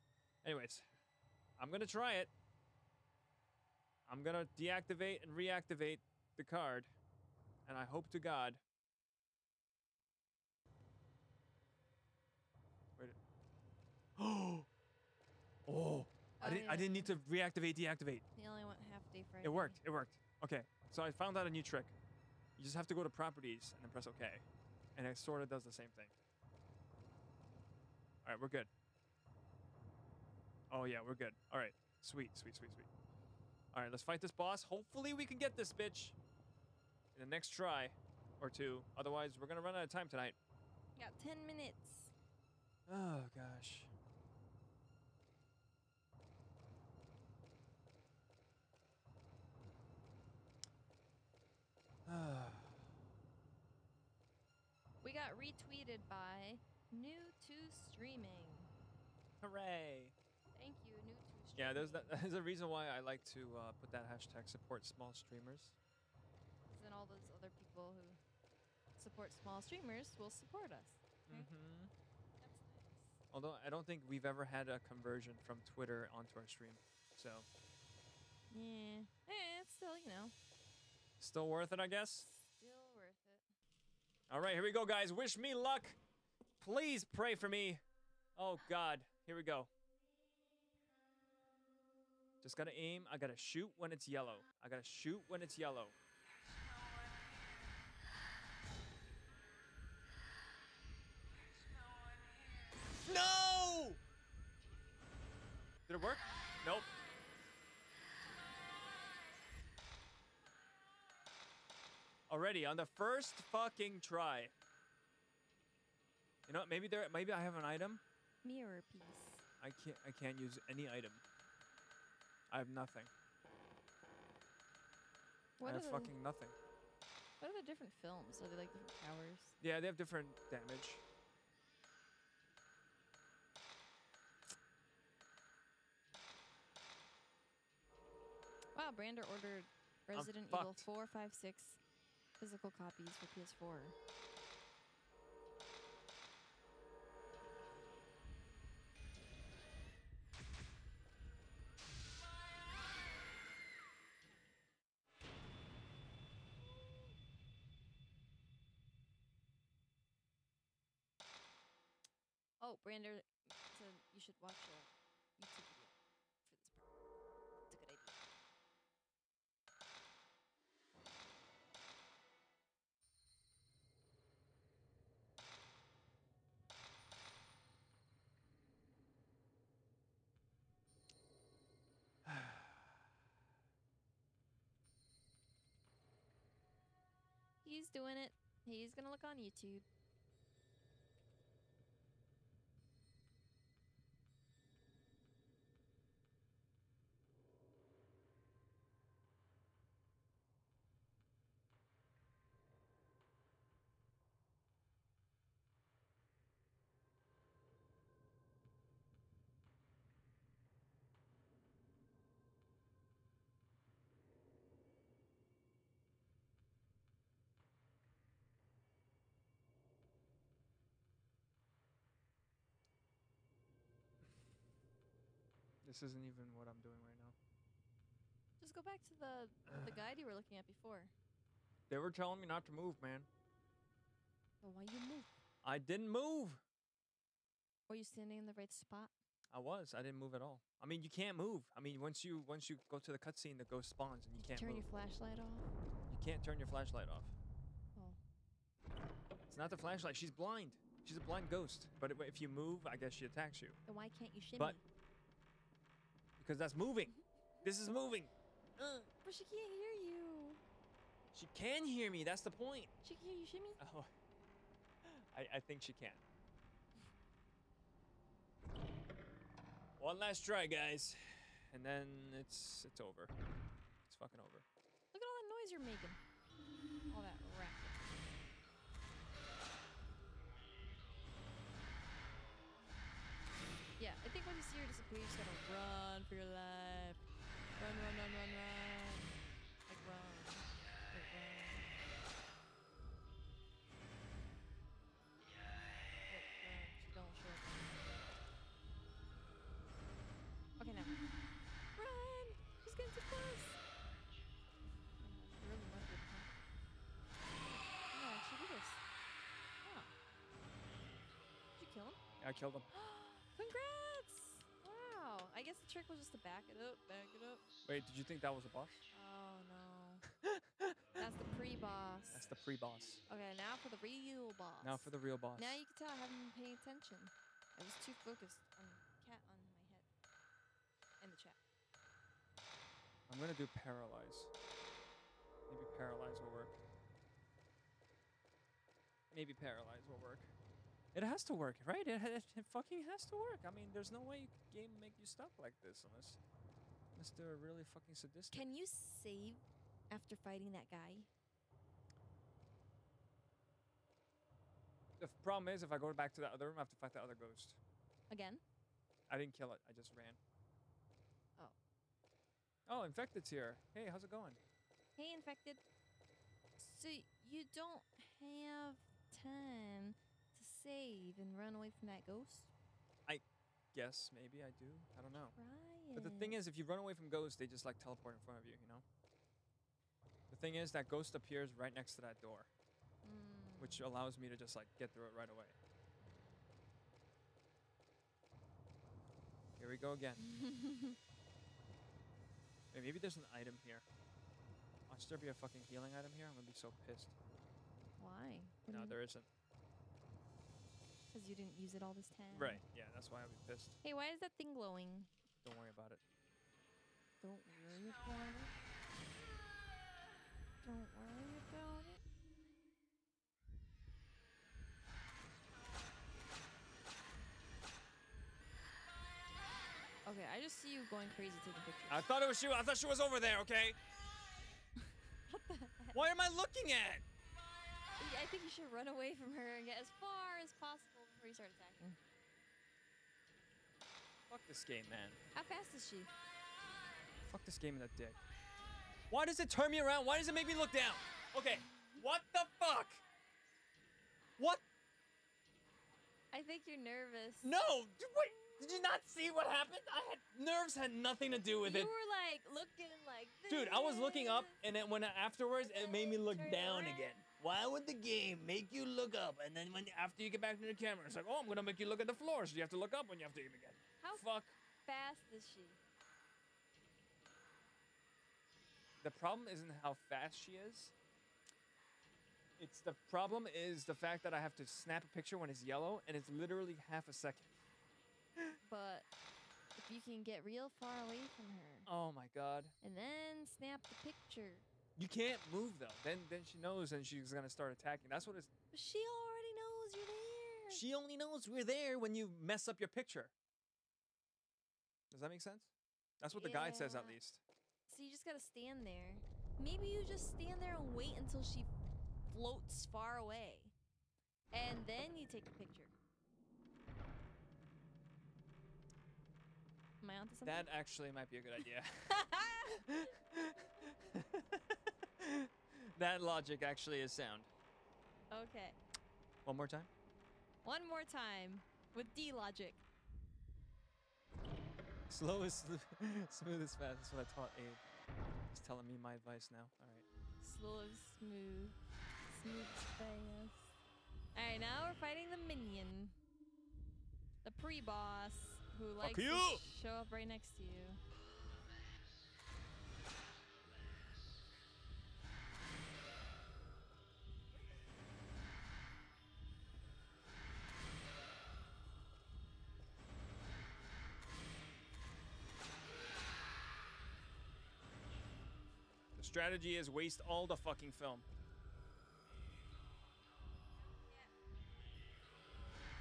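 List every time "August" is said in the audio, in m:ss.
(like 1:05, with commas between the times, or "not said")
not said.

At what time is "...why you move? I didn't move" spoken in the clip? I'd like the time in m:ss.
3:54.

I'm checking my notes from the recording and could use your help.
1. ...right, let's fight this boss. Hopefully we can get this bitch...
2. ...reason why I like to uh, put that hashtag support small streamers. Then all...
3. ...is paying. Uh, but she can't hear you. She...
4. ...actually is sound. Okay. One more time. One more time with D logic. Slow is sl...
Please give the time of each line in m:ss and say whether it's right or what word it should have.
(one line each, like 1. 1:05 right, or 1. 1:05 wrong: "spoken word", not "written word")
1. 0:33 right
2. 1:02 right
3. 4:17 wrong: "moving", not "paying"
4. 8:36 right.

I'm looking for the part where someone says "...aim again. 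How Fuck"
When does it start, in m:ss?
7:43.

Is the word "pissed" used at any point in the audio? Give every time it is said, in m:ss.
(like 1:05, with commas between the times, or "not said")
6:37, 6:43.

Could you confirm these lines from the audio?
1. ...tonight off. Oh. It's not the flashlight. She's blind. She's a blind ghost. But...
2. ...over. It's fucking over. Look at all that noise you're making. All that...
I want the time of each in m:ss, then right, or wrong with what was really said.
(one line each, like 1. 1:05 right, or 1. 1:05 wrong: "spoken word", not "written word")
1. 4:06 wrong: "flashlight", not "tonight"
2. 4:32 right.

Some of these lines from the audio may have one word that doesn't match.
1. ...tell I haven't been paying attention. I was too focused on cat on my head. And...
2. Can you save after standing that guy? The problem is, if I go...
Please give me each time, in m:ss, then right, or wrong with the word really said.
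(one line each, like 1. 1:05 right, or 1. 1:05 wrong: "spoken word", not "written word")
1. 5:25 right
2. 5:48 wrong: "fighting", not "standing".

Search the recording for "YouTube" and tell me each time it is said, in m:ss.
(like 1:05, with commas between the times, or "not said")
2:45, 3:09.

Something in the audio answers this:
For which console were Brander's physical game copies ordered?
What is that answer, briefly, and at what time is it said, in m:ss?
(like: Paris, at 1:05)
PS4, at 2:23.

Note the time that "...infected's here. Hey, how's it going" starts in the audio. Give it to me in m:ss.
6:03.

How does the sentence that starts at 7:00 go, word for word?
Okay, I just see you going crazy taking pictures.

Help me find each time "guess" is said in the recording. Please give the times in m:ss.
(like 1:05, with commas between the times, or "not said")
1:21, 4:12, 5:15, 6:13.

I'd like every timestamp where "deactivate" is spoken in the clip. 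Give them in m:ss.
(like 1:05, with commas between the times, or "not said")
0:04, 0:17.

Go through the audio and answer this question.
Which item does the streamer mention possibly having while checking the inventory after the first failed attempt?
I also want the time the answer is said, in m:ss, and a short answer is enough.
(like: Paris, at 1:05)
Mirror piece, at 1:58.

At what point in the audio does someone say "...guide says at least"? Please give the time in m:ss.
8:16.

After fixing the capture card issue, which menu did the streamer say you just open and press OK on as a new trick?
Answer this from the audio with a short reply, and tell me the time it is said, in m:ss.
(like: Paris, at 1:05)
Properties, at 0:23.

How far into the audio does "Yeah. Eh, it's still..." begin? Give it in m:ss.
1:18.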